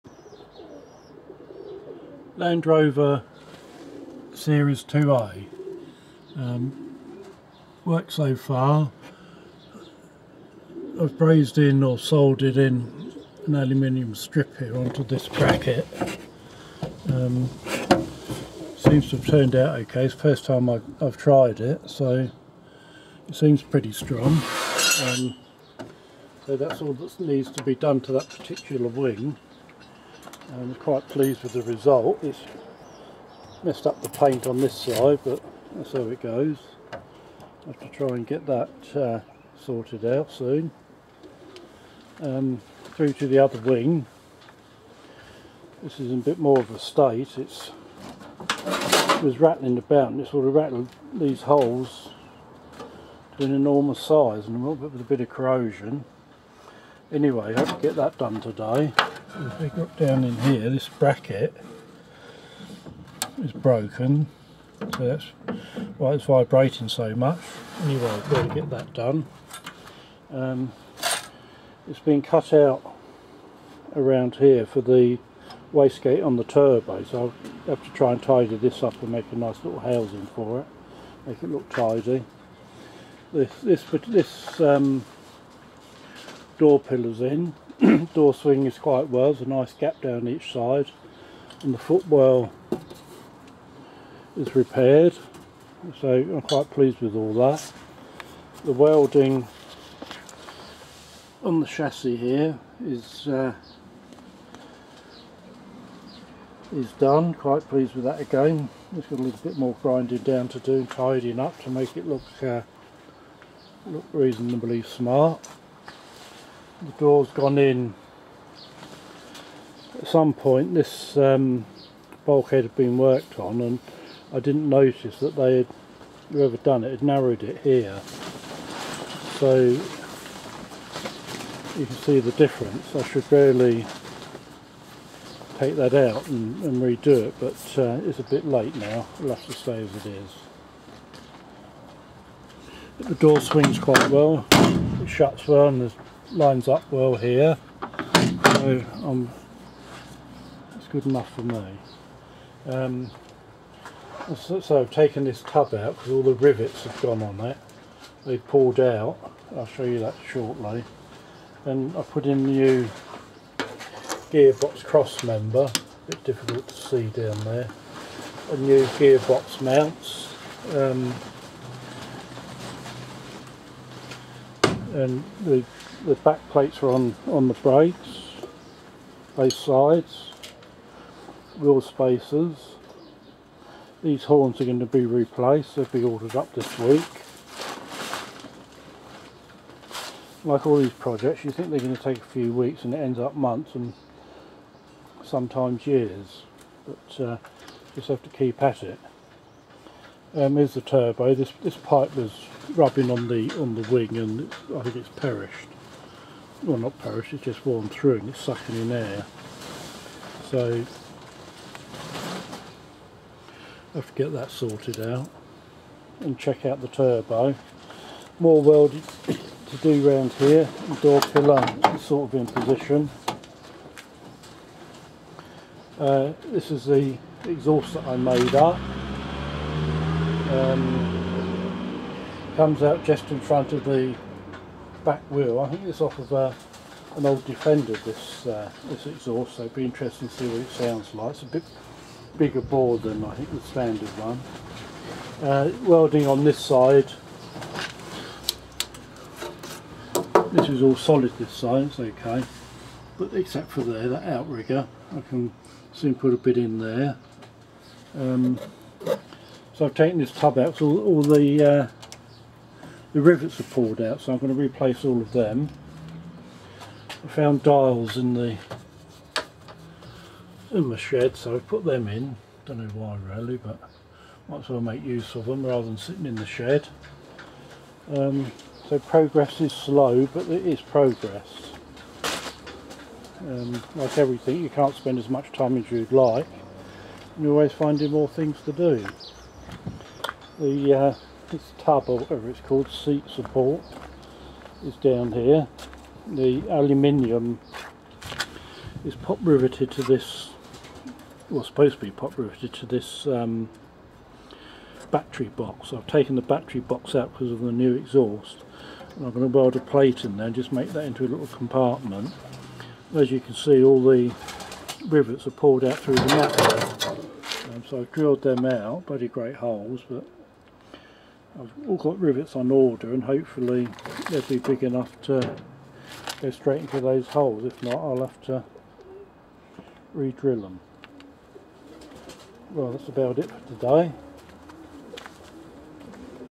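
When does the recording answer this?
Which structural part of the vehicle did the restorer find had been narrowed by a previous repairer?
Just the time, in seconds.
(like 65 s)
122 s.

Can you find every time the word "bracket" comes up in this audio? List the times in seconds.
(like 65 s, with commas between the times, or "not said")
15 s, 60 s.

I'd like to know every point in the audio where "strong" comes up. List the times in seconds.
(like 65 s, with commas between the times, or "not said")
23 s.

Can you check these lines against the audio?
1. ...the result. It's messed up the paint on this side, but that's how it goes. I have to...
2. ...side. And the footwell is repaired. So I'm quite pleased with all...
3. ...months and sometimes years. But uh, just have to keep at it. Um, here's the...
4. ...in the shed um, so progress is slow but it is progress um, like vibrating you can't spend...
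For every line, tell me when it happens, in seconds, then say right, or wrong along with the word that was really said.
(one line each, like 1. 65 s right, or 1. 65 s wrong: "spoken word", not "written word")
1. 31 s right
2. 90 s right
3. 193 s right
4. 276 s wrong: "everything", not "vibrating".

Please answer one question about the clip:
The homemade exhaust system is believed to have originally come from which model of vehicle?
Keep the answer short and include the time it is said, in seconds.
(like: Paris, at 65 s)
Defender, at 237 s.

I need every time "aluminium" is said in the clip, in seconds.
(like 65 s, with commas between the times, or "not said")
13 s, 296 s.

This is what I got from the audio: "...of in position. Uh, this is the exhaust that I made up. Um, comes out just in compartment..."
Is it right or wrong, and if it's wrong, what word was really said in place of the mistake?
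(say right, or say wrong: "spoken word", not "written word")
wrong: "front", not "compartment".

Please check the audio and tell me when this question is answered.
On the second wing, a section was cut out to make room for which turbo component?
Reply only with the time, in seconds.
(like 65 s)
75 s.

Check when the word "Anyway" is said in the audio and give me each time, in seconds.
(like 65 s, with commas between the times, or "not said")
57 s, 67 s.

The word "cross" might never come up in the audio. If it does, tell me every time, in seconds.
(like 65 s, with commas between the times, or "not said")
164 s.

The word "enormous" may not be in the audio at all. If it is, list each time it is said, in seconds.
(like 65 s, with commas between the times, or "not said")
53 s.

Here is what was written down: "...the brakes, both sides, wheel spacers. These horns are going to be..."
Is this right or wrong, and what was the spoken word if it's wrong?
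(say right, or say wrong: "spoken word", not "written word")
right.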